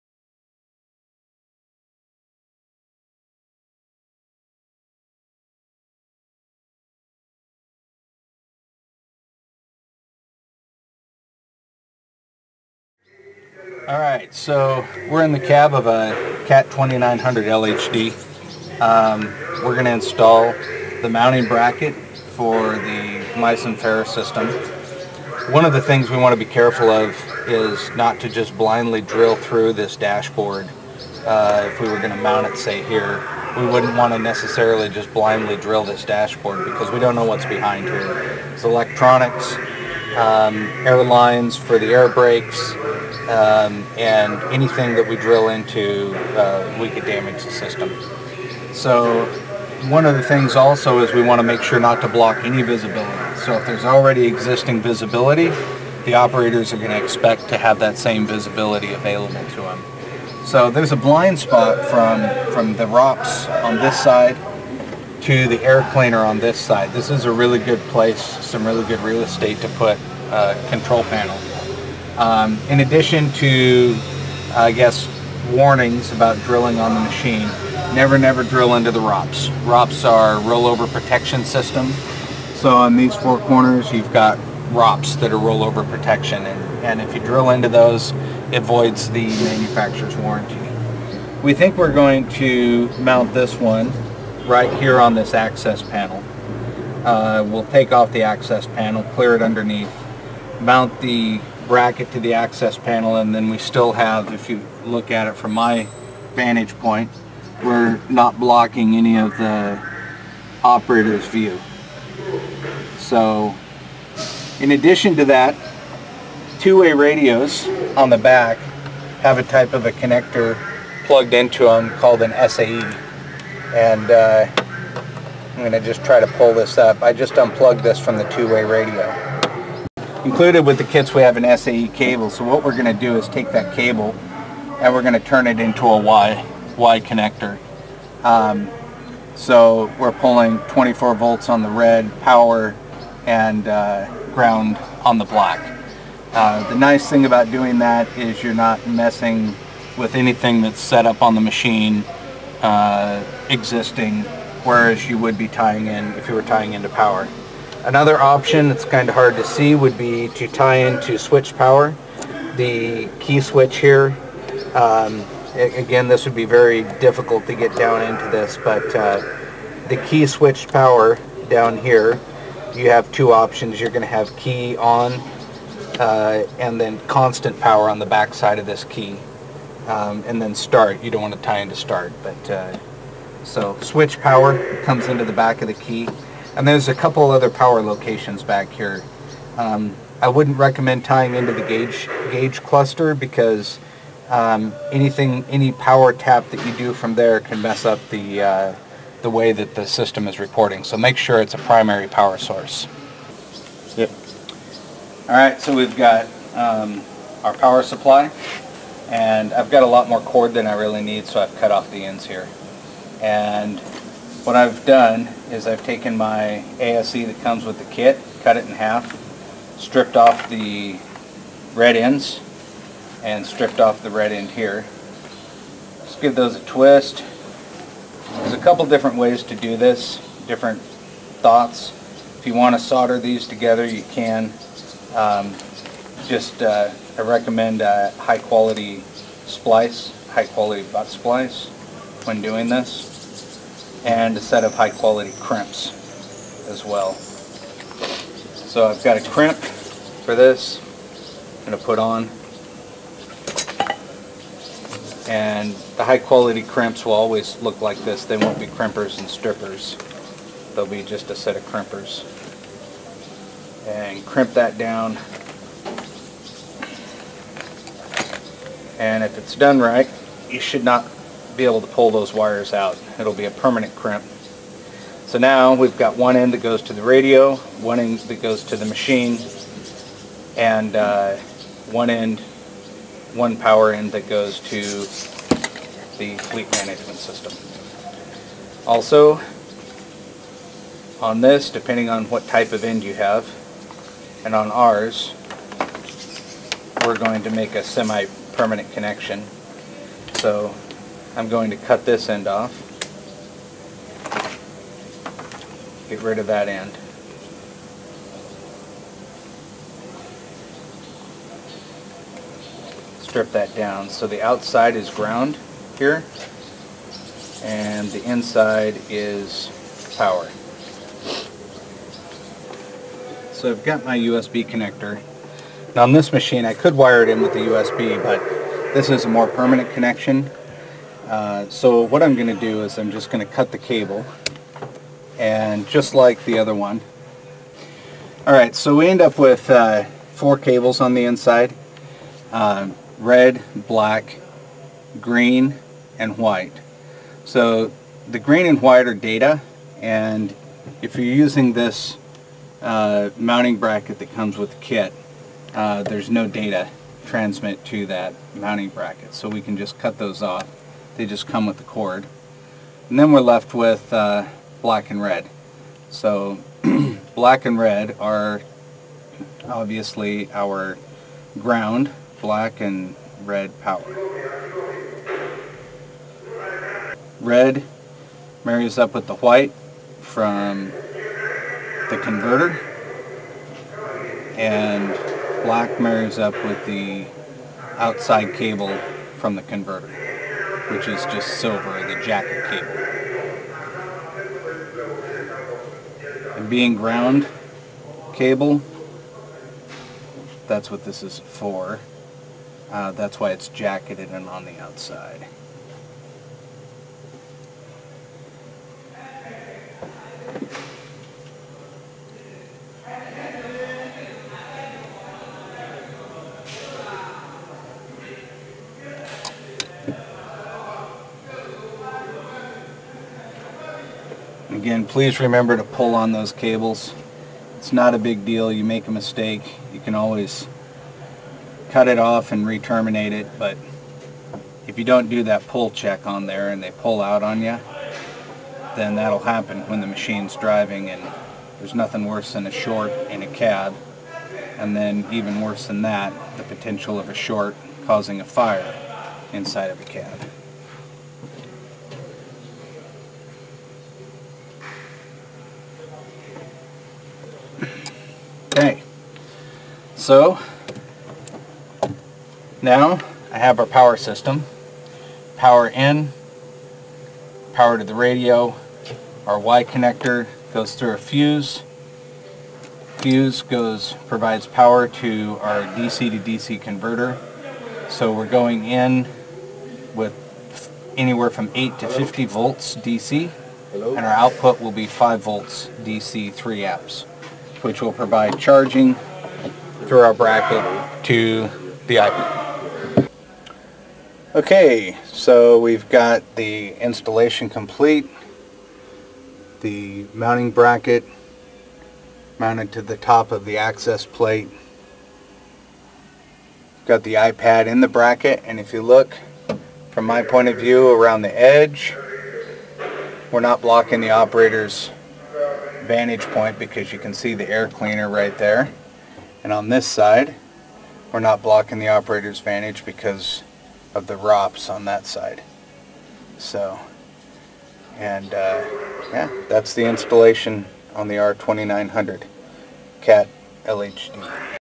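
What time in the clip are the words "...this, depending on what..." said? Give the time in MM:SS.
04:51.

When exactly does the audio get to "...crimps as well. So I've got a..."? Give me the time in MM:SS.
04:05.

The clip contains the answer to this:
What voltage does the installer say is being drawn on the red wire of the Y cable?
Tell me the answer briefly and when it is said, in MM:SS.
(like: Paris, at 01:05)
24 volts, at 02:20.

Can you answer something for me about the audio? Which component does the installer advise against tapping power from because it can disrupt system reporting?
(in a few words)
gauge cluster.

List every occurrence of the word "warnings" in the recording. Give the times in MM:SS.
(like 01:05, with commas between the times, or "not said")
01:15.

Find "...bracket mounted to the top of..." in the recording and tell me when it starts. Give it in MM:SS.
08:20.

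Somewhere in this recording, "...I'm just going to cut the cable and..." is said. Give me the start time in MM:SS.
05:32.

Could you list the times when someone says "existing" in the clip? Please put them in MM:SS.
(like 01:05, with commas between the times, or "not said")
00:54, 02:33.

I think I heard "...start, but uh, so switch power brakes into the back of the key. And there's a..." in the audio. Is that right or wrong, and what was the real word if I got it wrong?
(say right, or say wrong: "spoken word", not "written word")
wrong: "comes", not "brakes".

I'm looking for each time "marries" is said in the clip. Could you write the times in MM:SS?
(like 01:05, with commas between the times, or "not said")
06:18, 06:25.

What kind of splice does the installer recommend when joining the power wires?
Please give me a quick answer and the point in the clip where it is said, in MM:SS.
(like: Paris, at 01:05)
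butt splice, at 04:00.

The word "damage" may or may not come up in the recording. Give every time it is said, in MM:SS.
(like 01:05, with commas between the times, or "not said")
00:47.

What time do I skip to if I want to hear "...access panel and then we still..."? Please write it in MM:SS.
01:42.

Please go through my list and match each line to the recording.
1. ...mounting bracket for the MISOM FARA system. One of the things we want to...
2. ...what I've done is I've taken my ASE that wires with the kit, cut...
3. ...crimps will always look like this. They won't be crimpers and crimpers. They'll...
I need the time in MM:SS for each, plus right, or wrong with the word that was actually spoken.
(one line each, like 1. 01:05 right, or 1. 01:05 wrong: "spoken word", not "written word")
1. 00:21 right
2. 03:34 wrong: "comes", not "wires"
3. 04:16 wrong: "strippers", not "crimpers".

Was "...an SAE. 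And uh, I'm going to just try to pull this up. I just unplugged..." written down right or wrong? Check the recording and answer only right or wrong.
right.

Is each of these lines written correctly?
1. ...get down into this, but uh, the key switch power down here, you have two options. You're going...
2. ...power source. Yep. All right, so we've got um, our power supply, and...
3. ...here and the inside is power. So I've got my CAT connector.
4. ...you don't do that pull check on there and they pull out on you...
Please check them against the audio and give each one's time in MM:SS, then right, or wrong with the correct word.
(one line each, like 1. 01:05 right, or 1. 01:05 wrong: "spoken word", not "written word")
1. 02:47 right
2. 03:22 right
3. 05:15 wrong: "USB", not "CAT"
4. 07:14 right.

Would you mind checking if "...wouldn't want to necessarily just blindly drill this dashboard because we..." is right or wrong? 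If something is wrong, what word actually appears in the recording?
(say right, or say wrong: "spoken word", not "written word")
right.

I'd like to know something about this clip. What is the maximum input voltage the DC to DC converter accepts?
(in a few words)
50 volts.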